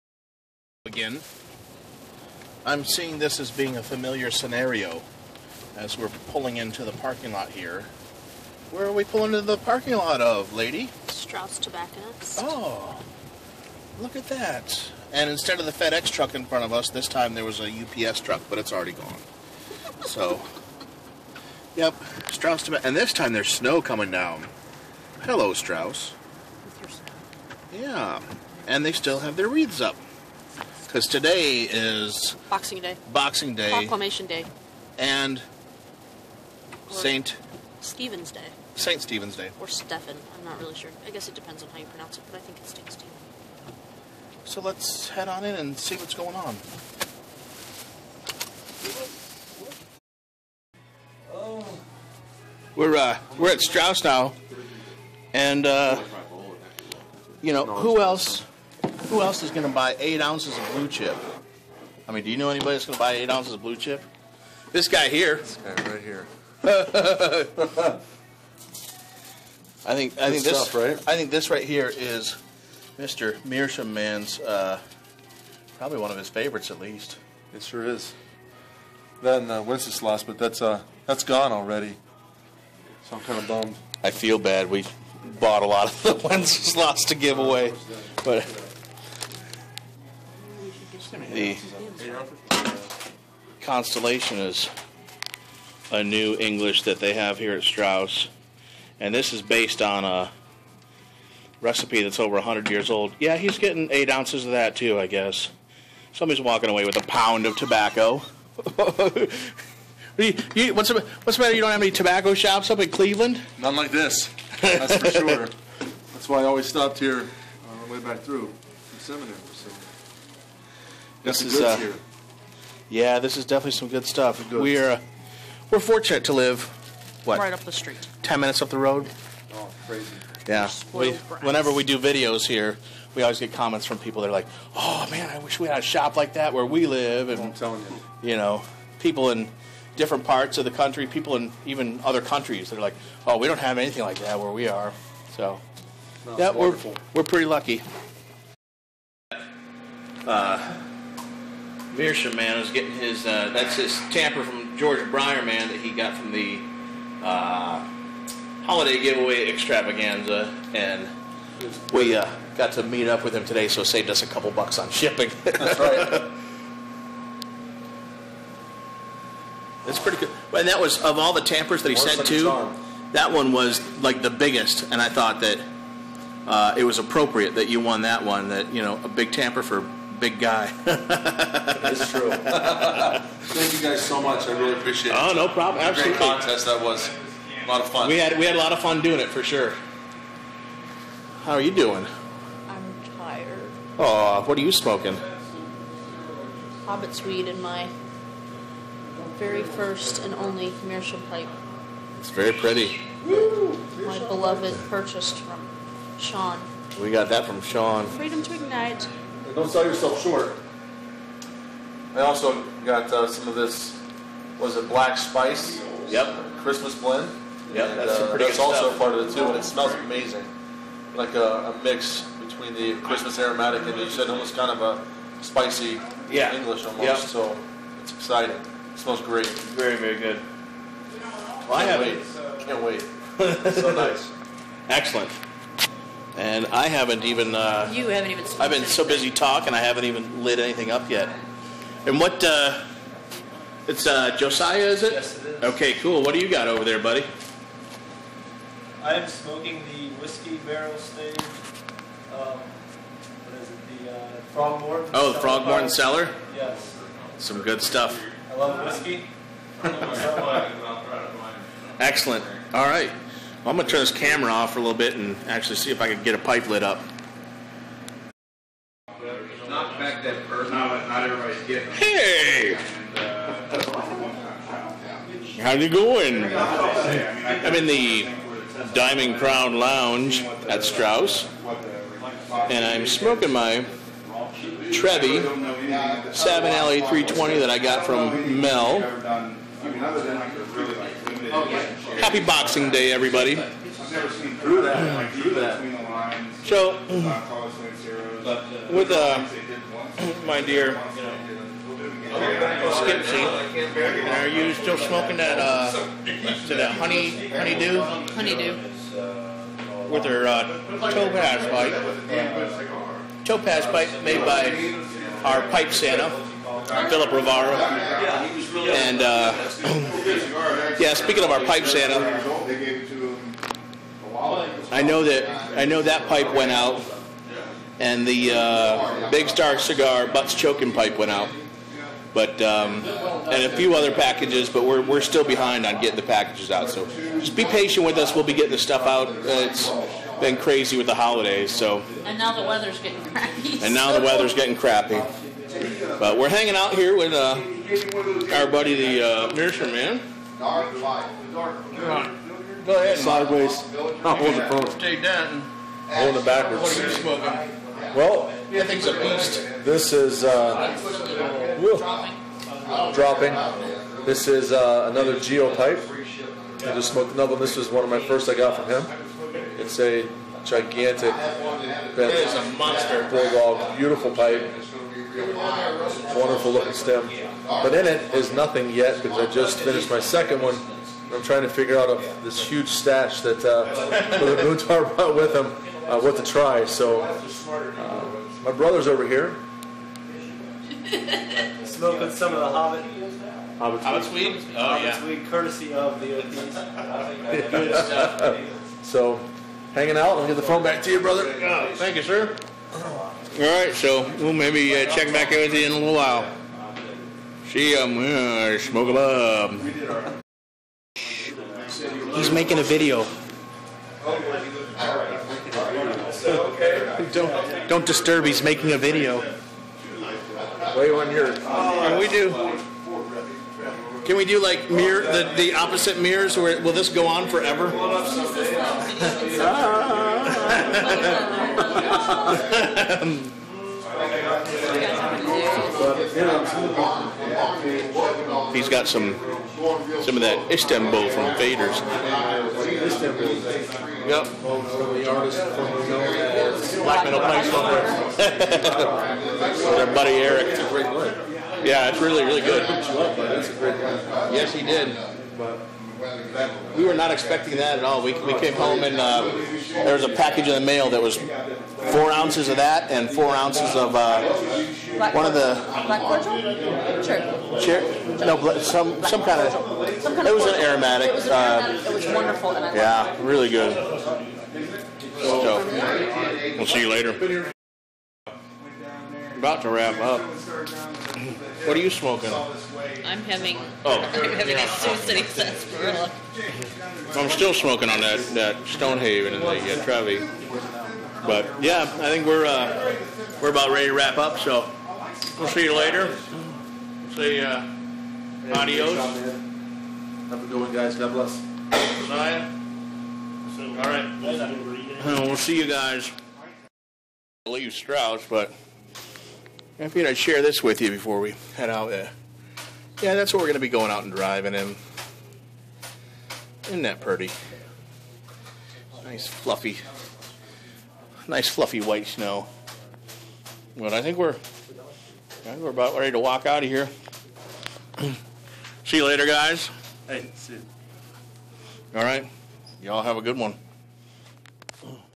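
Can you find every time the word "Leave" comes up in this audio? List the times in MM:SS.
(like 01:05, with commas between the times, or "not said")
08:27.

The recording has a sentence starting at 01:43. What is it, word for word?
Yeah, he's getting eight ounces of that too, I guess.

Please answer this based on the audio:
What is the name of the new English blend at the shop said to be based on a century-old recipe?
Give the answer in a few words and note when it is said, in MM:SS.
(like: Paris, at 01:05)
Constellation, at 01:33.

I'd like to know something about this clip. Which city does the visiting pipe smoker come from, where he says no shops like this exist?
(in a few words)
Cleveland.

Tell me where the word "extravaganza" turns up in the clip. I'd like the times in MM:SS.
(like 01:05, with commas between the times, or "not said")
02:39.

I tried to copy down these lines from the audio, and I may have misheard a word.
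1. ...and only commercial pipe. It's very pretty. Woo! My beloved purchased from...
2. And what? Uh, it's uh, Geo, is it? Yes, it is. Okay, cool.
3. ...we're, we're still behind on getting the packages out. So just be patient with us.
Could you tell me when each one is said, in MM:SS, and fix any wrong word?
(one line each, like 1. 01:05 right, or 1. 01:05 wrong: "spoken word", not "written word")
1. 03:20 right
2. 04:02 wrong: "Josiah", not "Geo"
3. 05:34 right.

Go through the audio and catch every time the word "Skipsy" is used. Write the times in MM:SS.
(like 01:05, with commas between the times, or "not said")
05:03.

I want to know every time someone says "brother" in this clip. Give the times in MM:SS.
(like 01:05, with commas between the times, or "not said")
06:28, 06:41.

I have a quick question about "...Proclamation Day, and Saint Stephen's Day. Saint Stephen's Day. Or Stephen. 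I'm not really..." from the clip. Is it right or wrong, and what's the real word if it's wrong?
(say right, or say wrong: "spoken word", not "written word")
right.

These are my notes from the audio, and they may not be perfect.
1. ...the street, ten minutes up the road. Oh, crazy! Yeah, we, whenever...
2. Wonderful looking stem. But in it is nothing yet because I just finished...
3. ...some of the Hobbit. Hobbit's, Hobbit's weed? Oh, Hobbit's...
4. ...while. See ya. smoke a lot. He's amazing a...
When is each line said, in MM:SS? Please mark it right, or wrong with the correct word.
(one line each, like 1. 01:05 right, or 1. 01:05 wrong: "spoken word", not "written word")
1. 02:07 right
2. 06:16 right
3. 06:32 right
4. 06:46 wrong: "making", not "amazing".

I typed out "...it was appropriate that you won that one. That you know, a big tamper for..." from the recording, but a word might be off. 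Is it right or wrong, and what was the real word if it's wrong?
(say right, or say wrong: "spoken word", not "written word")
right.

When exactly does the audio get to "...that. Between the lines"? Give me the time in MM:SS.
04:55.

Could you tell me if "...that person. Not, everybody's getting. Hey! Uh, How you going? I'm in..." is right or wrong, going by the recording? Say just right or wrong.
right.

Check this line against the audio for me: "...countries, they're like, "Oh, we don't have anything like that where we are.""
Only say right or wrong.
right.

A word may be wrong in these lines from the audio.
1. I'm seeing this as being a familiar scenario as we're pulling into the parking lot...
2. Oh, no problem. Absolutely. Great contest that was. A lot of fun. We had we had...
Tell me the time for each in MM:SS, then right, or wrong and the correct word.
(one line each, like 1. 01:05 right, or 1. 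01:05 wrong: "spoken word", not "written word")
1. 00:02 right
2. 03:05 right.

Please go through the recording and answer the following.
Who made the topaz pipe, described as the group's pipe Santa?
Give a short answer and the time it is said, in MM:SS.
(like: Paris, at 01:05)
Philip Rivara, at 05:16.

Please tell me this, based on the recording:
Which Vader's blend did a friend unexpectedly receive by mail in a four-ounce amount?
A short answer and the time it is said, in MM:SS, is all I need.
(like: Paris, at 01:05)
Istanbul, at 07:20.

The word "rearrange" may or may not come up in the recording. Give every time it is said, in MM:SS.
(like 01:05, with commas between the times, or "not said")
not said.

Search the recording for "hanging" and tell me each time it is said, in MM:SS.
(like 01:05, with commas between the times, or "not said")
05:46, 06:39.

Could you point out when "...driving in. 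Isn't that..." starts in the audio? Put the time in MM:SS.
08:34.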